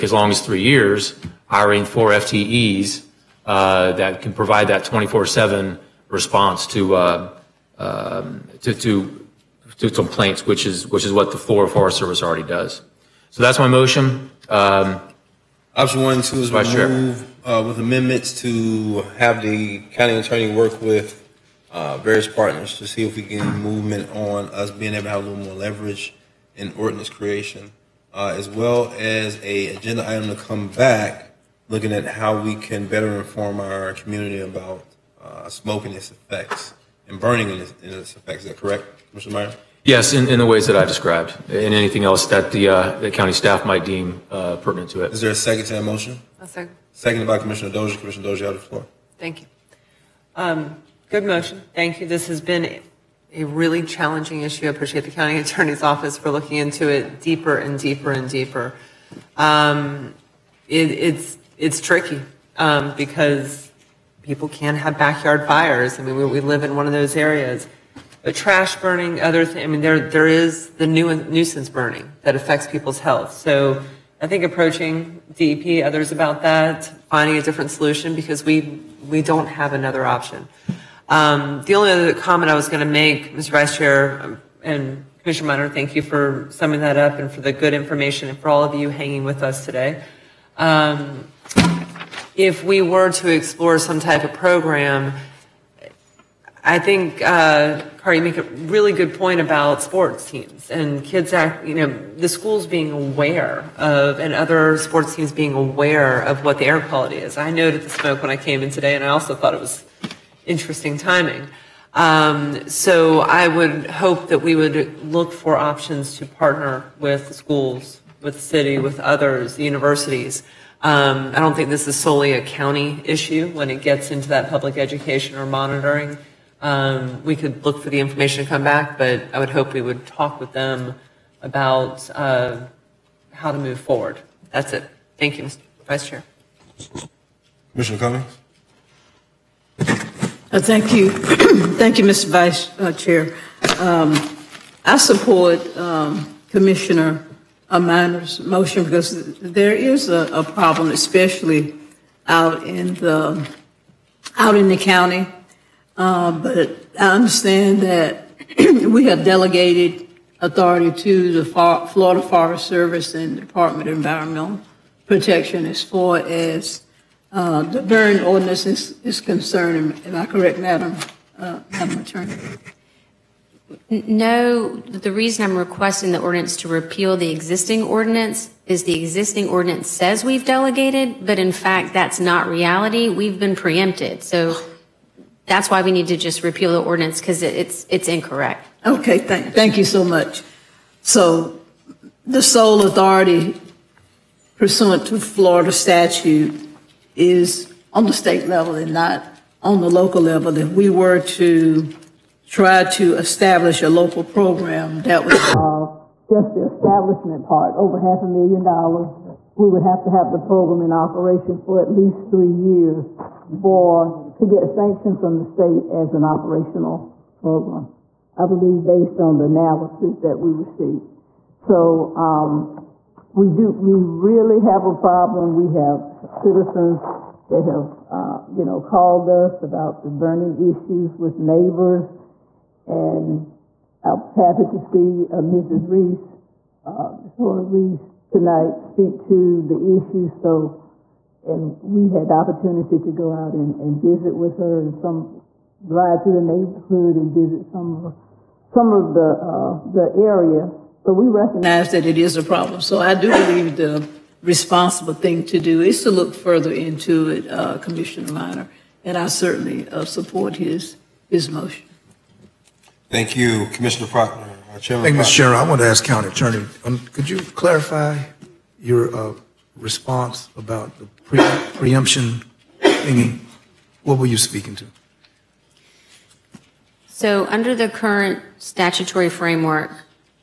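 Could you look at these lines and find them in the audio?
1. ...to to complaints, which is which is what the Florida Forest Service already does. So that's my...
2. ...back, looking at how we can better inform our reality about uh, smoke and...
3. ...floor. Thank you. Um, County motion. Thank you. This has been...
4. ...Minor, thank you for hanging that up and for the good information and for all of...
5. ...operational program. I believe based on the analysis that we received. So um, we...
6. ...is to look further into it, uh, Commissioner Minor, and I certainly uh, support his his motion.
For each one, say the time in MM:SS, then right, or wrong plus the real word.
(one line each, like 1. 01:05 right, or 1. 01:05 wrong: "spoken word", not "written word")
1. 00:08 right
2. 00:30 wrong: "community", not "reality"
3. 00:48 wrong: "Good", not "County"
4. 01:25 wrong: "summing", not "hanging"
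5. 03:36 right
6. 04:15 right.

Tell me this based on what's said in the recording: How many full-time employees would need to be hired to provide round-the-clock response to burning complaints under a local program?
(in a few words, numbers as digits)
4.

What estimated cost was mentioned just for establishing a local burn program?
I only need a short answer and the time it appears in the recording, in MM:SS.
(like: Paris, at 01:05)
over half a million dollars, at 03:27.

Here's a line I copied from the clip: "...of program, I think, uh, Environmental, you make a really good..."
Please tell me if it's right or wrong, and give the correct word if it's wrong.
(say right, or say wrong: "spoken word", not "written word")
wrong: "Carl", not "Environmental".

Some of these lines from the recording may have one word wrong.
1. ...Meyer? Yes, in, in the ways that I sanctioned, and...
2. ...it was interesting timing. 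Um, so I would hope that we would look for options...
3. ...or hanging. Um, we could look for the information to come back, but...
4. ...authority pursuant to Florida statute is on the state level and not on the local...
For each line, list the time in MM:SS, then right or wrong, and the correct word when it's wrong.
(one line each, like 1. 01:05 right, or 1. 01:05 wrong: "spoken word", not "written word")
1. 00:39 wrong: "described", not "sanctioned"
2. 01:49 right
3. 02:05 wrong: "monitoring", not "hanging"
4. 03:12 right.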